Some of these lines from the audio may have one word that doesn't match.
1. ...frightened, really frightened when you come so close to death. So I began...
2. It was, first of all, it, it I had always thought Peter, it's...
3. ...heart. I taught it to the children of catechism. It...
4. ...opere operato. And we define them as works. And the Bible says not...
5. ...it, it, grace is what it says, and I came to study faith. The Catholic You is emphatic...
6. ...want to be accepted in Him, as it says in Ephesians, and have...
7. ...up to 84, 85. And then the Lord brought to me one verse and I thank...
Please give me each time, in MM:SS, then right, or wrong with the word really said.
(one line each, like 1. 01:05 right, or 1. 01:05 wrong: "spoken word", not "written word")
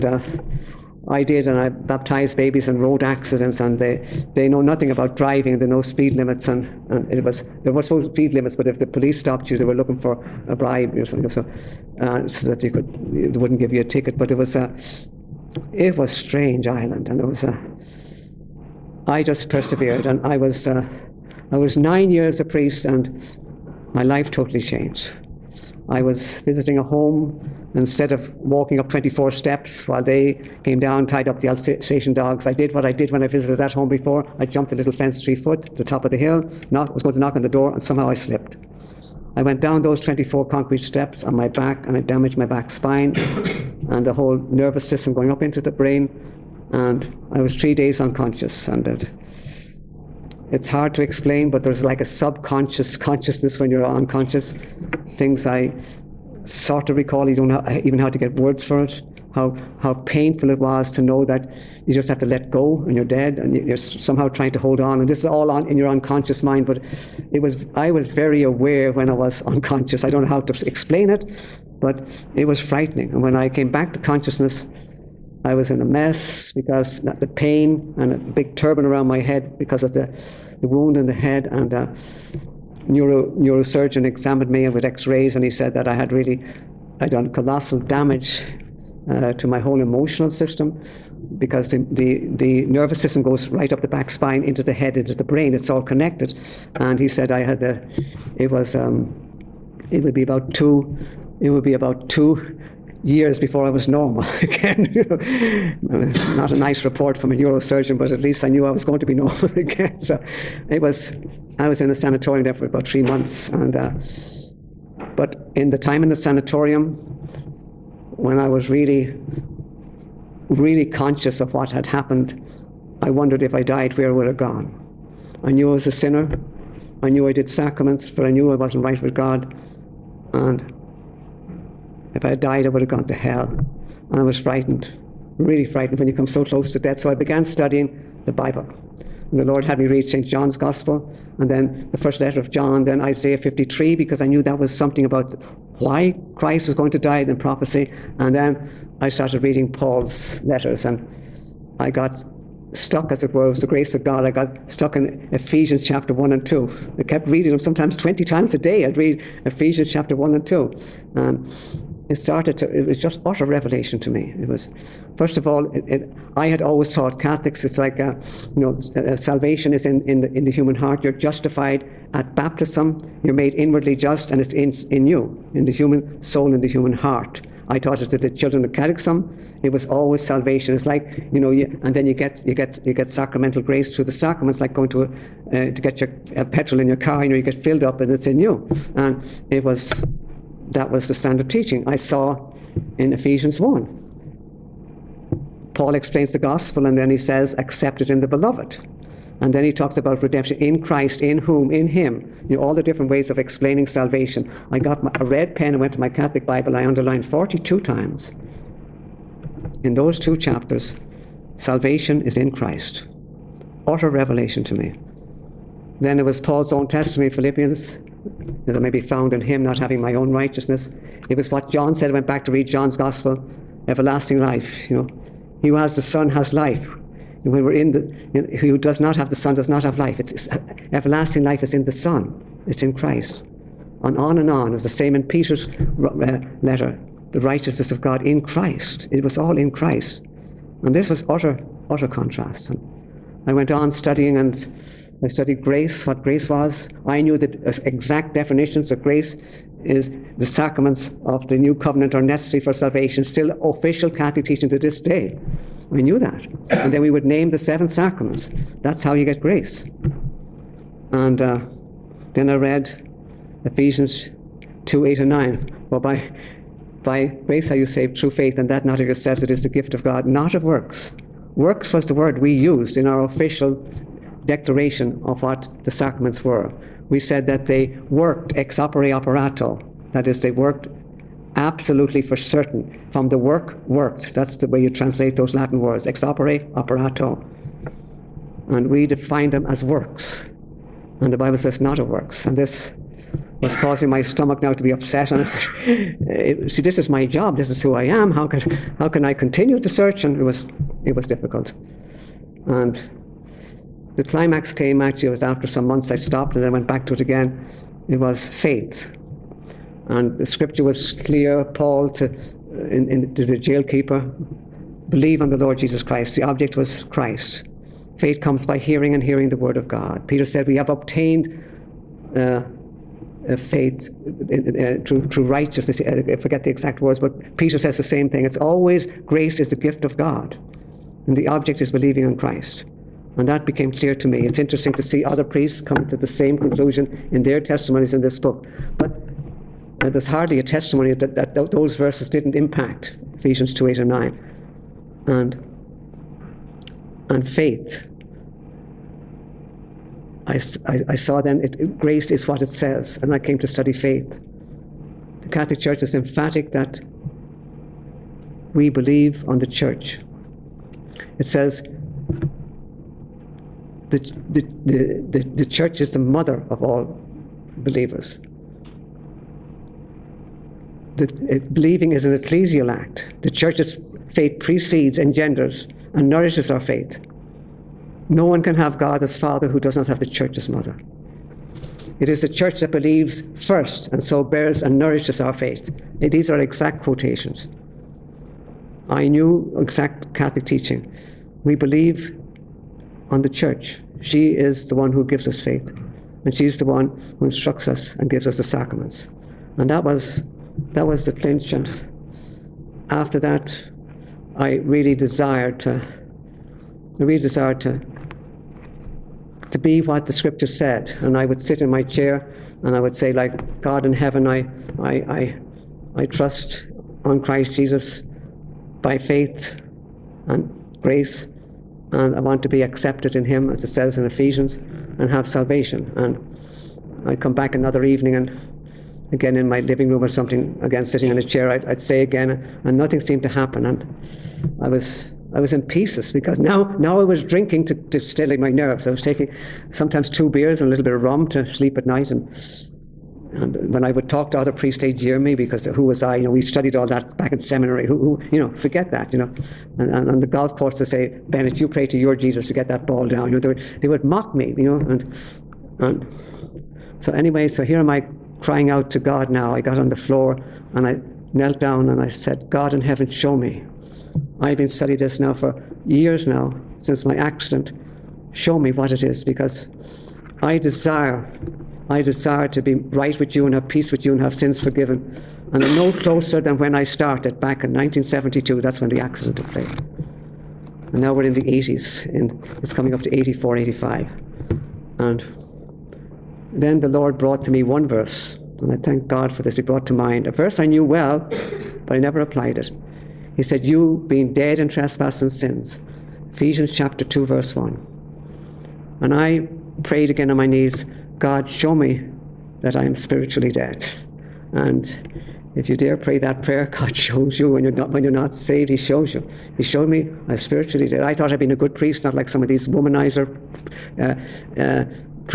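1. 02:14 right
2. 02:44 wrong: "Catholics", not "Peter"
3. 02:56 right
4. 04:46 right
5. 05:51 wrong: "Church", not "You"
6. 07:02 right
7. 08:03 right.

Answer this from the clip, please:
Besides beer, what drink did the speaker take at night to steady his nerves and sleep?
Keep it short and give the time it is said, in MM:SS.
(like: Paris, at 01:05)
rum, at 07:21.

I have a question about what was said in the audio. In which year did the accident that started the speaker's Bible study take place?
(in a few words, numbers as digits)
1972.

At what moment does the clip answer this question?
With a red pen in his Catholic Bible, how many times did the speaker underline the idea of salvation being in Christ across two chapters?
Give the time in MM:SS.
03:27.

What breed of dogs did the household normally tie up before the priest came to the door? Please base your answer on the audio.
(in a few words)
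Alsatian.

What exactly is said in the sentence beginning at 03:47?
when we're in the, you know, who does not have the Son does not have life.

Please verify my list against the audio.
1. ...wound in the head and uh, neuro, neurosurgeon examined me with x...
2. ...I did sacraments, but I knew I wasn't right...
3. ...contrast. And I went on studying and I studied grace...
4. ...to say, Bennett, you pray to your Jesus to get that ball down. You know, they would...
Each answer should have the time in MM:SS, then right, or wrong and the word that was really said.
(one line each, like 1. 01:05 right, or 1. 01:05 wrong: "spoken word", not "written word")
1. 01:20 right
2. 02:07 right
3. 04:02 right
4. 07:30 right.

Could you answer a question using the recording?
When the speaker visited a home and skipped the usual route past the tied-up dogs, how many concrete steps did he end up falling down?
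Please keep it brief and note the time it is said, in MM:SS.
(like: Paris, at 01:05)
24, at 00:39.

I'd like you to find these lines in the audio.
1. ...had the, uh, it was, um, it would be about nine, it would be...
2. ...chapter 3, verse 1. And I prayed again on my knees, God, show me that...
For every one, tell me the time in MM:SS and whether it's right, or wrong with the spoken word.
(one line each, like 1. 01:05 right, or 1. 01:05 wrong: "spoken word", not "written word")
1. 01:37 wrong: "two", not "nine"
2. 08:16 wrong: "2", not "3".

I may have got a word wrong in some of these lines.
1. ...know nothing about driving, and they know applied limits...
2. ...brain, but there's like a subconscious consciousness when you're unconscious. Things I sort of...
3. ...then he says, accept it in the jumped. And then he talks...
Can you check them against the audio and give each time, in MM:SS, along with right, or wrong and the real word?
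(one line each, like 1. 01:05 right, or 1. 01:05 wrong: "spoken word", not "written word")
1. 00:04 wrong: "speed", not "applied"
2. 00:51 wrong: "explain", not "brain"
3. 03:16 wrong: "beloved", not "jumped".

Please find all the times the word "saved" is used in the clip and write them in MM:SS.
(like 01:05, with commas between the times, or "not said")
04:27, 08:28.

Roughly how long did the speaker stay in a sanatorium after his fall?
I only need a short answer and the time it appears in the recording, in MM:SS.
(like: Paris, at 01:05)
3 months, at 01:52.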